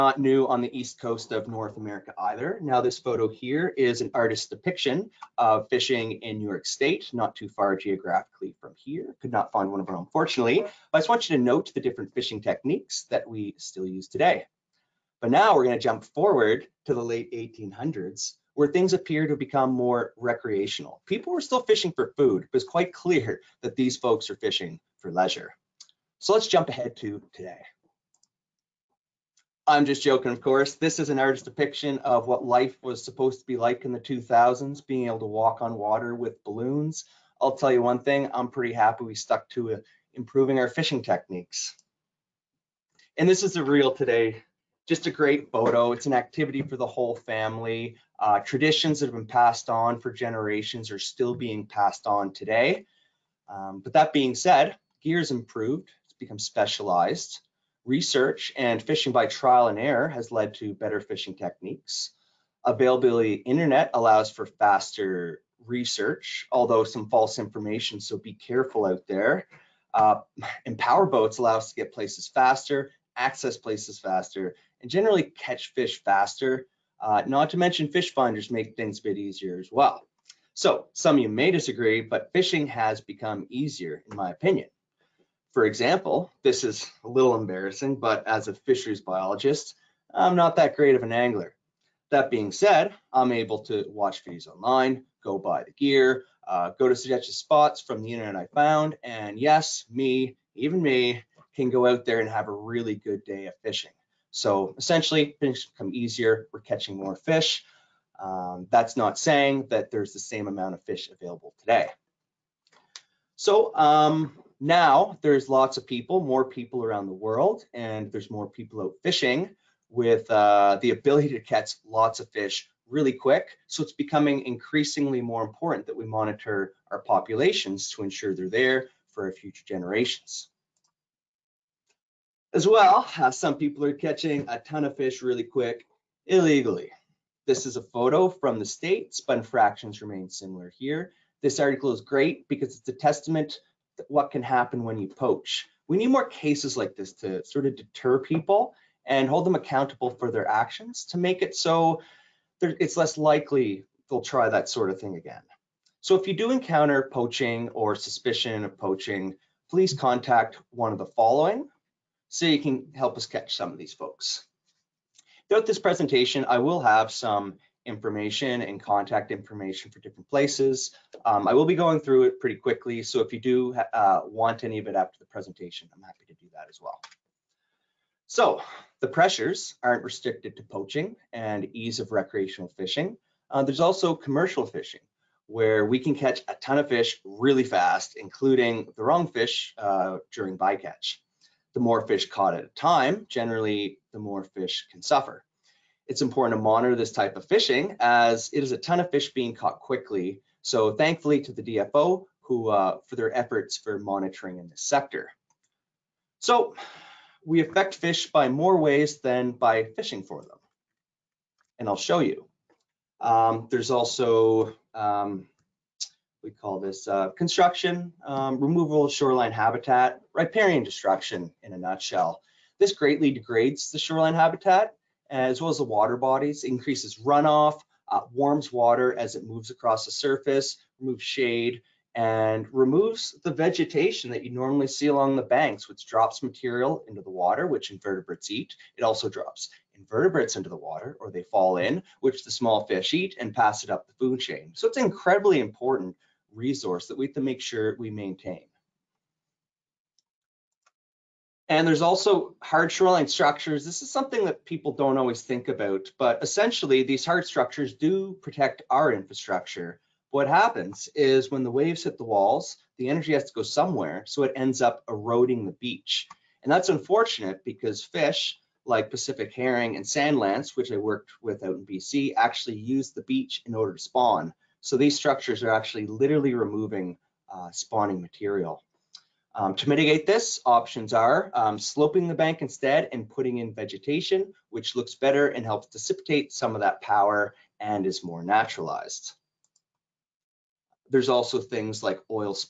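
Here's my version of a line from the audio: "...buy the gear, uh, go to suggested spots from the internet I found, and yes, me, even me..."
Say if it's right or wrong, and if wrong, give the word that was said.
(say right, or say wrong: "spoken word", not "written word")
right.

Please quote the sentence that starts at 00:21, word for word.
People were still fishing for food, but it's quite clear that these folks are fishing for leisure.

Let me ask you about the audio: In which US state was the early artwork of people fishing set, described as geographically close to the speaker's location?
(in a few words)
New York State.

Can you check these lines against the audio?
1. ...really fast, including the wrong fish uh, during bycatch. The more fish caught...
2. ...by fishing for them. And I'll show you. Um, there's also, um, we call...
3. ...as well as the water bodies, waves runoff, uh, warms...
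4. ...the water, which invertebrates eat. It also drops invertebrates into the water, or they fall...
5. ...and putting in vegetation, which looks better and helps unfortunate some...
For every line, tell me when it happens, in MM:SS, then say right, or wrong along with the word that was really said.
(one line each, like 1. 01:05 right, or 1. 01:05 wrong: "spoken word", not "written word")
1. 03:07 right
2. 03:29 right
3. 03:45 wrong: "increases", not "waves"
4. 03:57 right
5. 04:43 wrong: "dissipate", not "unfortunate".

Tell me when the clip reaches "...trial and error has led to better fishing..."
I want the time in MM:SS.
00:59.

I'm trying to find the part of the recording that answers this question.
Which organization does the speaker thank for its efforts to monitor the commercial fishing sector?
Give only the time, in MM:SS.
03:21.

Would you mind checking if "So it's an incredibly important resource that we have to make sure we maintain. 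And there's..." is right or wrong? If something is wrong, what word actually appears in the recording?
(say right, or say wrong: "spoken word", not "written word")
right.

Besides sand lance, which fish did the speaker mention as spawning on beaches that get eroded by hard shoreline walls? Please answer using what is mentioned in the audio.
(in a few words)
Pacific herring.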